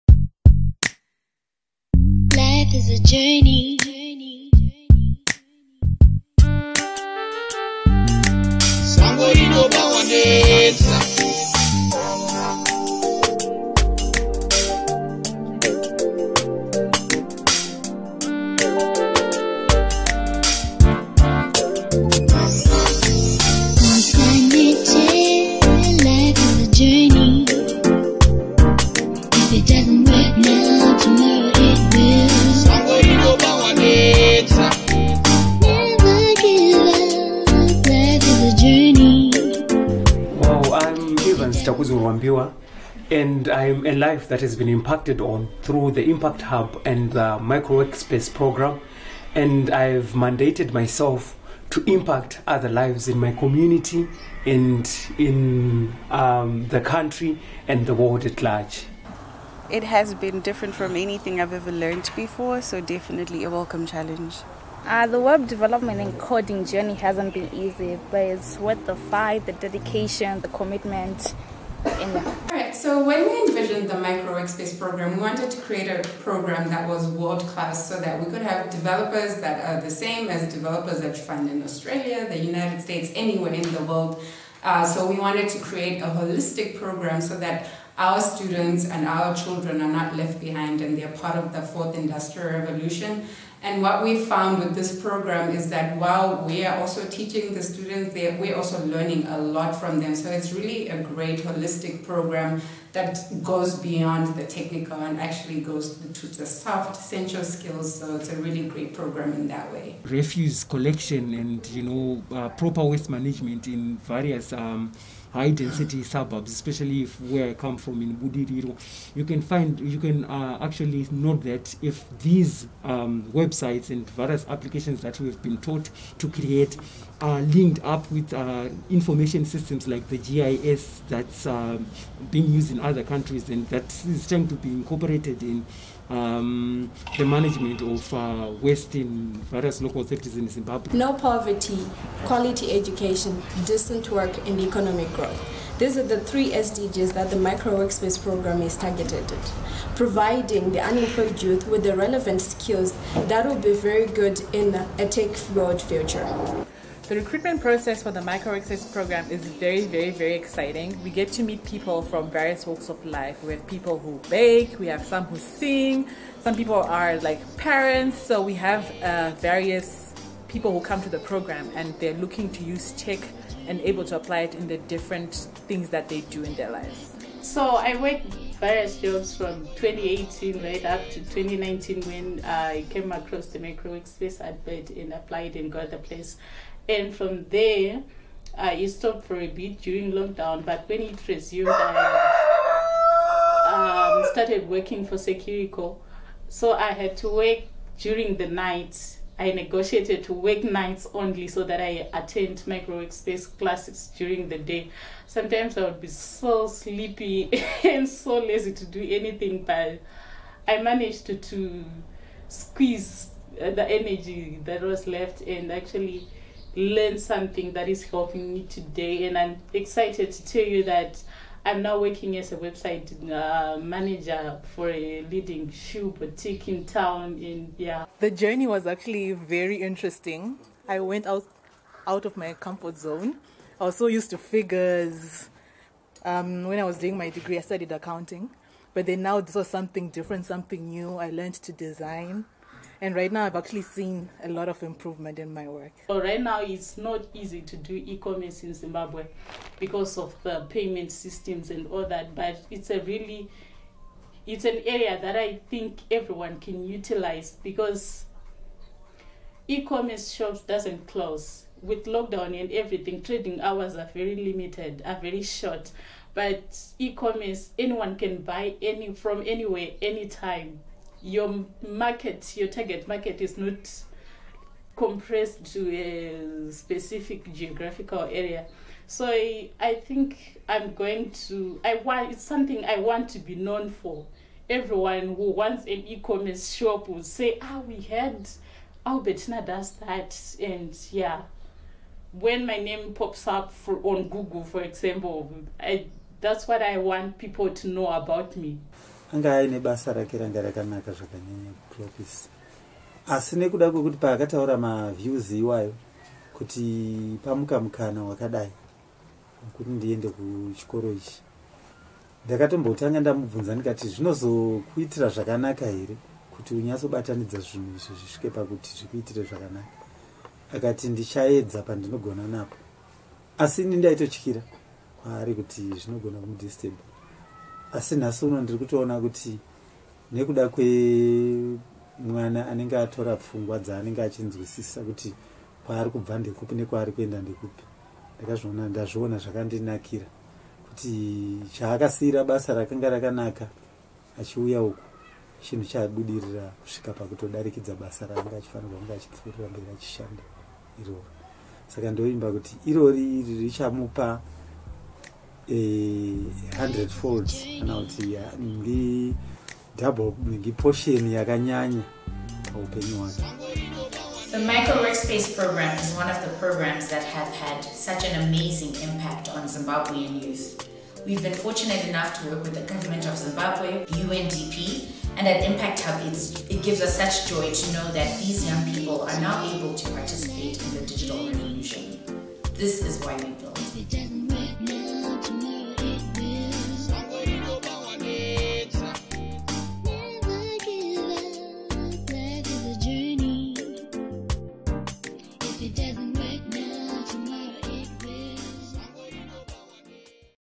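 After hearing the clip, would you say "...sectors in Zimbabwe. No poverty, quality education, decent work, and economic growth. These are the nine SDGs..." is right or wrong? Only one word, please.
wrong.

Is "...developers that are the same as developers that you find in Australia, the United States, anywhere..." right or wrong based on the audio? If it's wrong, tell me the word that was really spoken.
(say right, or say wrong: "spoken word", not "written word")
right.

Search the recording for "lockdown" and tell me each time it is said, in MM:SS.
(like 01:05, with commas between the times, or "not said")
03:10, 04:22.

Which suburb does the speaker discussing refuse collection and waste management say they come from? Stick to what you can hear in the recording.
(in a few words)
Budiriro.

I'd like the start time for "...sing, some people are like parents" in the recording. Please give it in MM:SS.
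02:45.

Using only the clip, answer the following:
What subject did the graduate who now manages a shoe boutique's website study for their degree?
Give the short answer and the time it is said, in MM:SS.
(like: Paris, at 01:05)
Accounting, at 03:57.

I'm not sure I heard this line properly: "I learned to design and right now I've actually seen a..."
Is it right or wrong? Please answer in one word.
right.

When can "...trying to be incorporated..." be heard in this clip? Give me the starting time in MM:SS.
02:14.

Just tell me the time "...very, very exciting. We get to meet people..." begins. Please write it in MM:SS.
02:39.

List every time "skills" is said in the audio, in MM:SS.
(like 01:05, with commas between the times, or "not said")
01:47, 02:32.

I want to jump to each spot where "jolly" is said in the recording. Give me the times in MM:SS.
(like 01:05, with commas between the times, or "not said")
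not said.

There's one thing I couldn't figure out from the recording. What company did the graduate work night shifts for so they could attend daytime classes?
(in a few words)
Securico.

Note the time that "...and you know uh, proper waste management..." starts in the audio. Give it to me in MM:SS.
01:51.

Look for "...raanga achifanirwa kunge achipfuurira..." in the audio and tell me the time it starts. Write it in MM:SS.
05:48.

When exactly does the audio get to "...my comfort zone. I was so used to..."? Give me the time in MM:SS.
03:52.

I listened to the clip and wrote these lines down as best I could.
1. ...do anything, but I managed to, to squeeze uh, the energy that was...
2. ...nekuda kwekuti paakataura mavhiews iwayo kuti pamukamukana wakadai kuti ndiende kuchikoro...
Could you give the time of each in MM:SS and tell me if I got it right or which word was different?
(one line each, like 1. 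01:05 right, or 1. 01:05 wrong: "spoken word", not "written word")
1. 03:28 right
2. 05:03 right.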